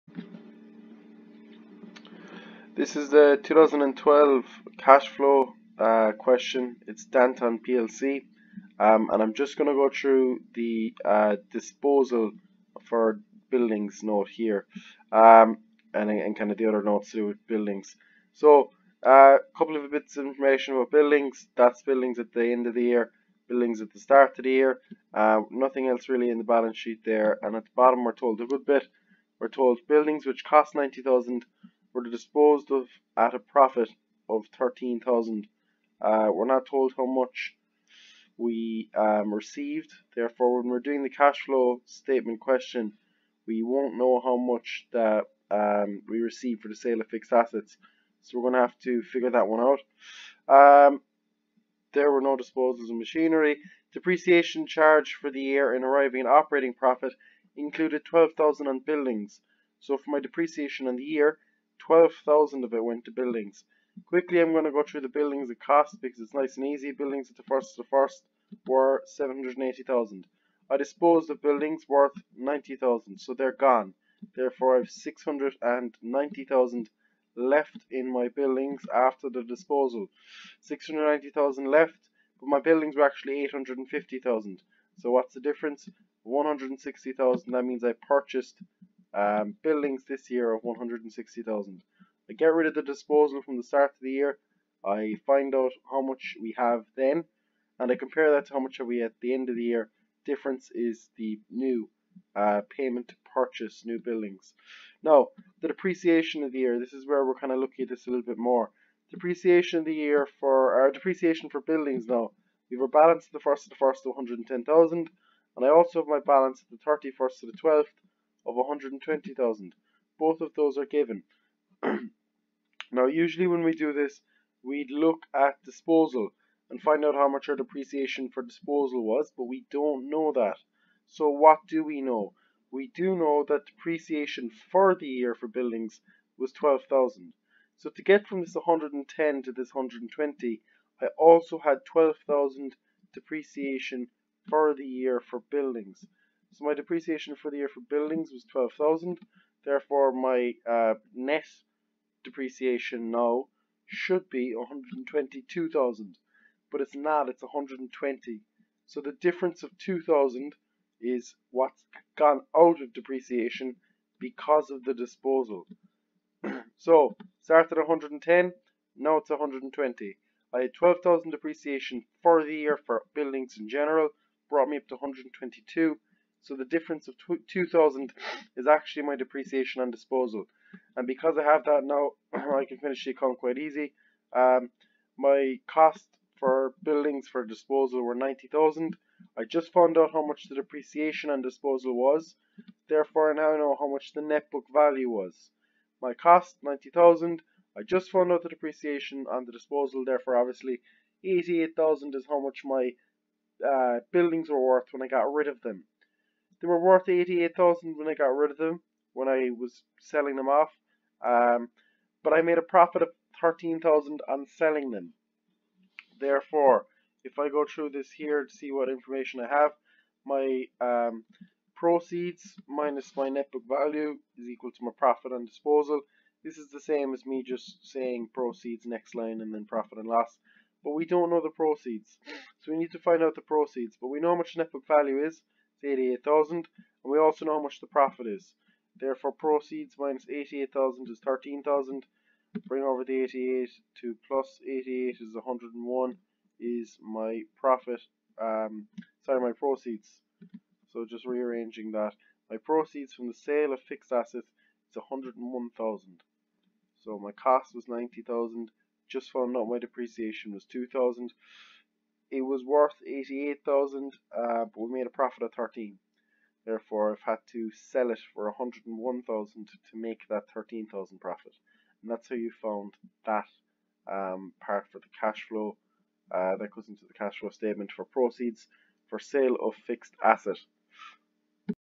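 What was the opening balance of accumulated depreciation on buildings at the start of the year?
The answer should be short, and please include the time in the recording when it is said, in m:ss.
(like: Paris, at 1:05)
110,000, at 1:54.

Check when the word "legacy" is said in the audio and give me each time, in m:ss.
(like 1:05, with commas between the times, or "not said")
not said.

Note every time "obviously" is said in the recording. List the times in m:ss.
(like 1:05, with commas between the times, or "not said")
3:20.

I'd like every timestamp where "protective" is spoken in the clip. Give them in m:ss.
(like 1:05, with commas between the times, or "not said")
not said.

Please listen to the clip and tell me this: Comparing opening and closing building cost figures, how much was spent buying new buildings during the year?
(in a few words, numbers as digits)
160,000.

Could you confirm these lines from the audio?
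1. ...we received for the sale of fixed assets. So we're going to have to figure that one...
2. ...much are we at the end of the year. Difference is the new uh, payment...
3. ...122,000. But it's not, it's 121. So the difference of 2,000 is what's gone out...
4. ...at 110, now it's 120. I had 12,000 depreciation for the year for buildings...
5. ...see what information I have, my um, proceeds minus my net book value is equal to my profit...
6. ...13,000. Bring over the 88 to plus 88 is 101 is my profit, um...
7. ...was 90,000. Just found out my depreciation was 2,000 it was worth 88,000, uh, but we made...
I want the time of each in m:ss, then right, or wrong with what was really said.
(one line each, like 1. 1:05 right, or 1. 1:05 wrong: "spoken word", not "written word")
1. 0:46 right
2. 1:38 right
3. 2:34 wrong: "120", not "121"
4. 2:47 right
5. 3:38 right
6. 4:01 right
7. 4:17 right.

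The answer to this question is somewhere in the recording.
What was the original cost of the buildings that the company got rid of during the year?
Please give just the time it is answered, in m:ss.
0:29.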